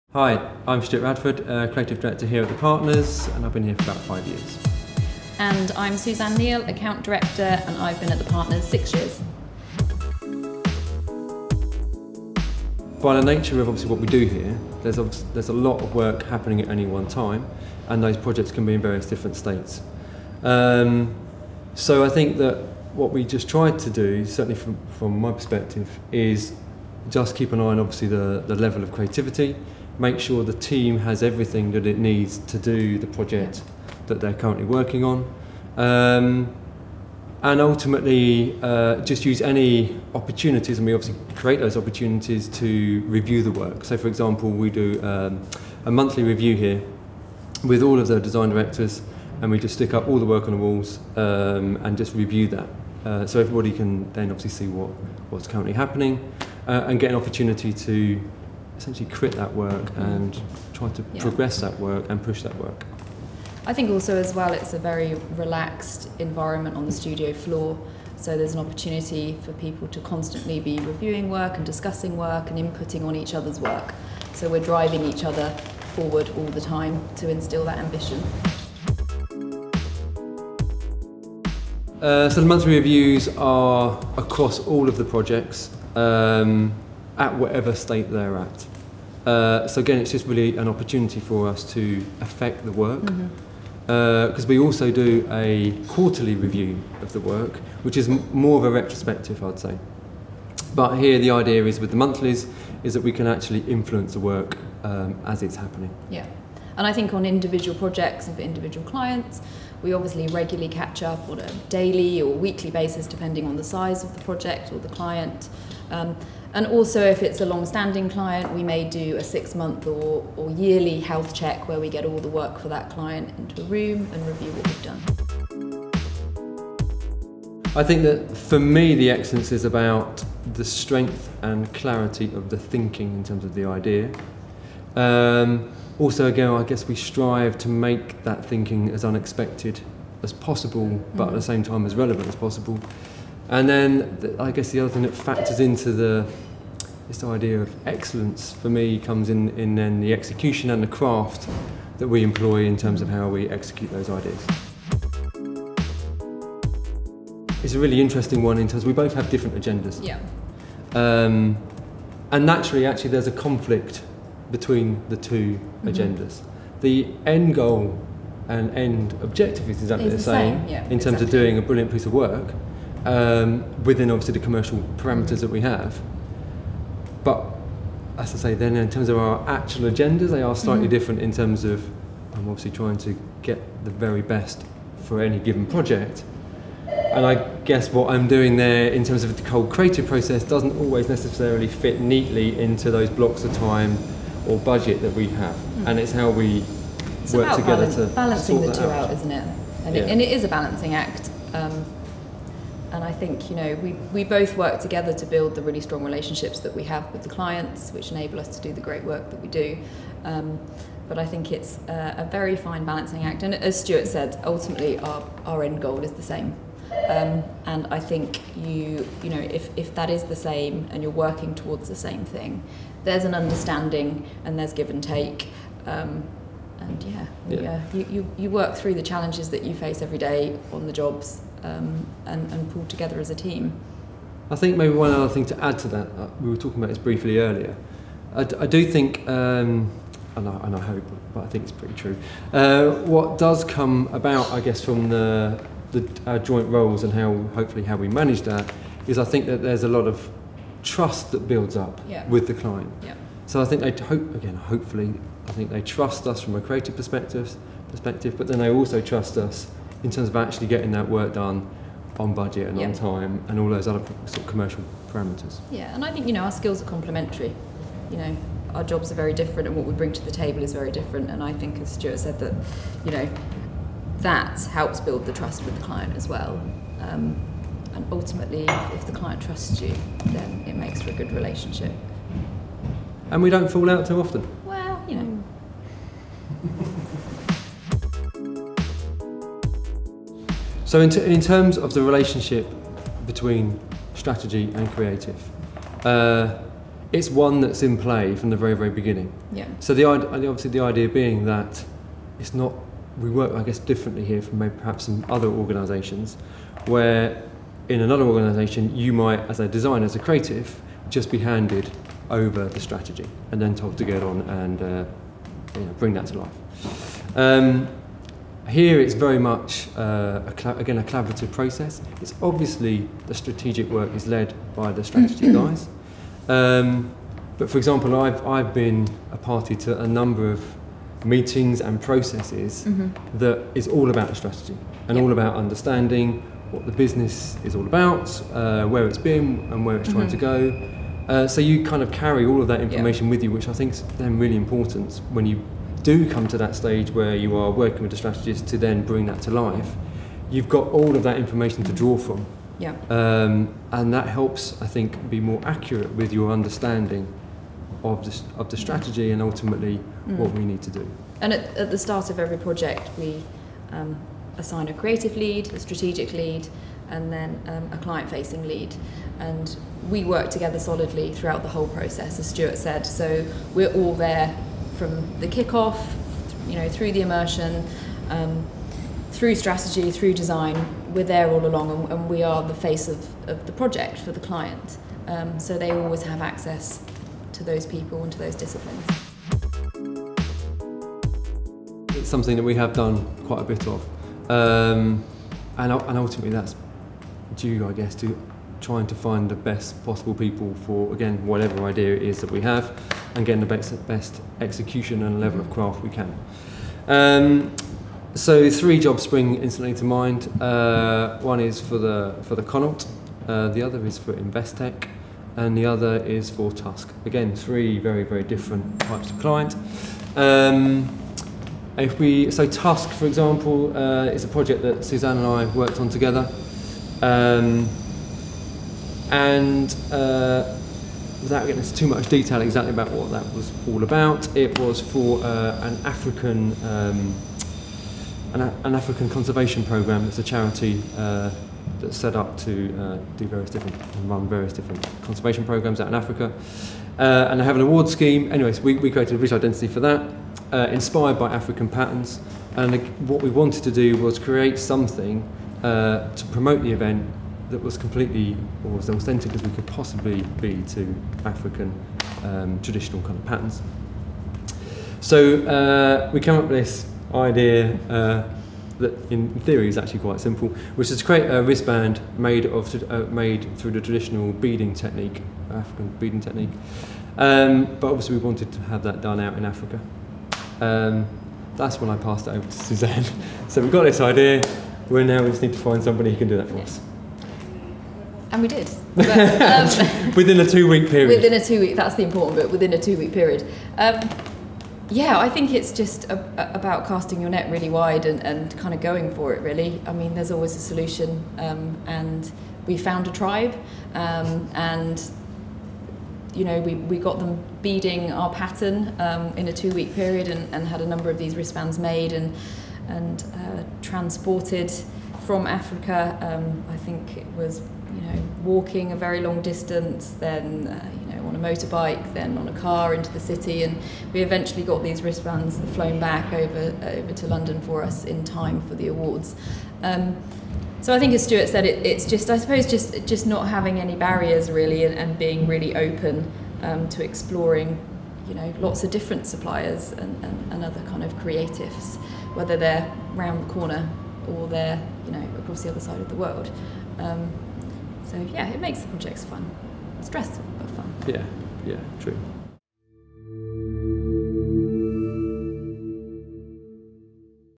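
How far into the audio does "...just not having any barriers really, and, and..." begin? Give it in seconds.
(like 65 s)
533 s.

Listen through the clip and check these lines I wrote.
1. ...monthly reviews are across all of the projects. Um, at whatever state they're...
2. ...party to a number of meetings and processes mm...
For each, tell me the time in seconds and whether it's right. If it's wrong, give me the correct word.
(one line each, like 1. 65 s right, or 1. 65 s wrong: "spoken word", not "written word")
1. 82 s right
2. 329 s right.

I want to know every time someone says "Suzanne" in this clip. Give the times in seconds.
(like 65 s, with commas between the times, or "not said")
5 s, 425 s, 482 s.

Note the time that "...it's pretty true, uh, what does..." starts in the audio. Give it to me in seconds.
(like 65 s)
241 s.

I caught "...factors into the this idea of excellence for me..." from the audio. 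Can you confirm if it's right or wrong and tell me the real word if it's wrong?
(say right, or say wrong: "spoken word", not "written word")
right.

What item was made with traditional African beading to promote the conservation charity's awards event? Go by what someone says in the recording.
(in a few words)
wristband.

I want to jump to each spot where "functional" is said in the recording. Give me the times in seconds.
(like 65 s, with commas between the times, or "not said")
not said.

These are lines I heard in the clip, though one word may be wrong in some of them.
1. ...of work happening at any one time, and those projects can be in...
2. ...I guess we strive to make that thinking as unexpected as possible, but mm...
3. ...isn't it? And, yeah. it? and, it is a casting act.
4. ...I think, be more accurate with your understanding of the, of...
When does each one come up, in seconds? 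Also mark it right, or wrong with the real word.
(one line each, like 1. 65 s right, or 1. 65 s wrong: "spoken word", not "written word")
1. 15 s right
2. 136 s right
3. 199 s wrong: "balancing", not "casting"
4. 354 s right.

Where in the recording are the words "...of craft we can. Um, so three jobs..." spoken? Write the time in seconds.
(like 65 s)
405 s.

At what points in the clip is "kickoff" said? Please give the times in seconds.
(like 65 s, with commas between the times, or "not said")
375 s.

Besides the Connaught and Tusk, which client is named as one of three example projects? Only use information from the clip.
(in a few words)
Investec.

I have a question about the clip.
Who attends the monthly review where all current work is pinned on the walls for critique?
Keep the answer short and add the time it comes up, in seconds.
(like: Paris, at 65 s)
design directors, at 48 s.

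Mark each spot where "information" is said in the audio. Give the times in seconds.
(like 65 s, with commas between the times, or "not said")
342 s, 351 s.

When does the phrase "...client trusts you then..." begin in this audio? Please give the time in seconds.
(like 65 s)
279 s.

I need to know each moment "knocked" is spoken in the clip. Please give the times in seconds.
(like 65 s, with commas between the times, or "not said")
not said.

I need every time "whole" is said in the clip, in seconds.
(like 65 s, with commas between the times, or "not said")
189 s, 371 s.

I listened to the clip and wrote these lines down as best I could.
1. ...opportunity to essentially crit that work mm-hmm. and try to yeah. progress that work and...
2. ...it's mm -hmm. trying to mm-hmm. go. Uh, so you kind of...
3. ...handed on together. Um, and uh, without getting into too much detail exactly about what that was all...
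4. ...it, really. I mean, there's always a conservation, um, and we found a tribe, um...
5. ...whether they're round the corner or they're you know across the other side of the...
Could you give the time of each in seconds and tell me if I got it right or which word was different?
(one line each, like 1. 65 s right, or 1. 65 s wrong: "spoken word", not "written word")
1. 57 s right
2. 339 s right
3. 425 s wrong: "worked", not "handed"
4. 499 s wrong: "solution", not "conservation"
5. 542 s right.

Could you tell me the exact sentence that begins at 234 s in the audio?
I think maybe one other thing to add to that, uh, we were talking about this briefly earlier.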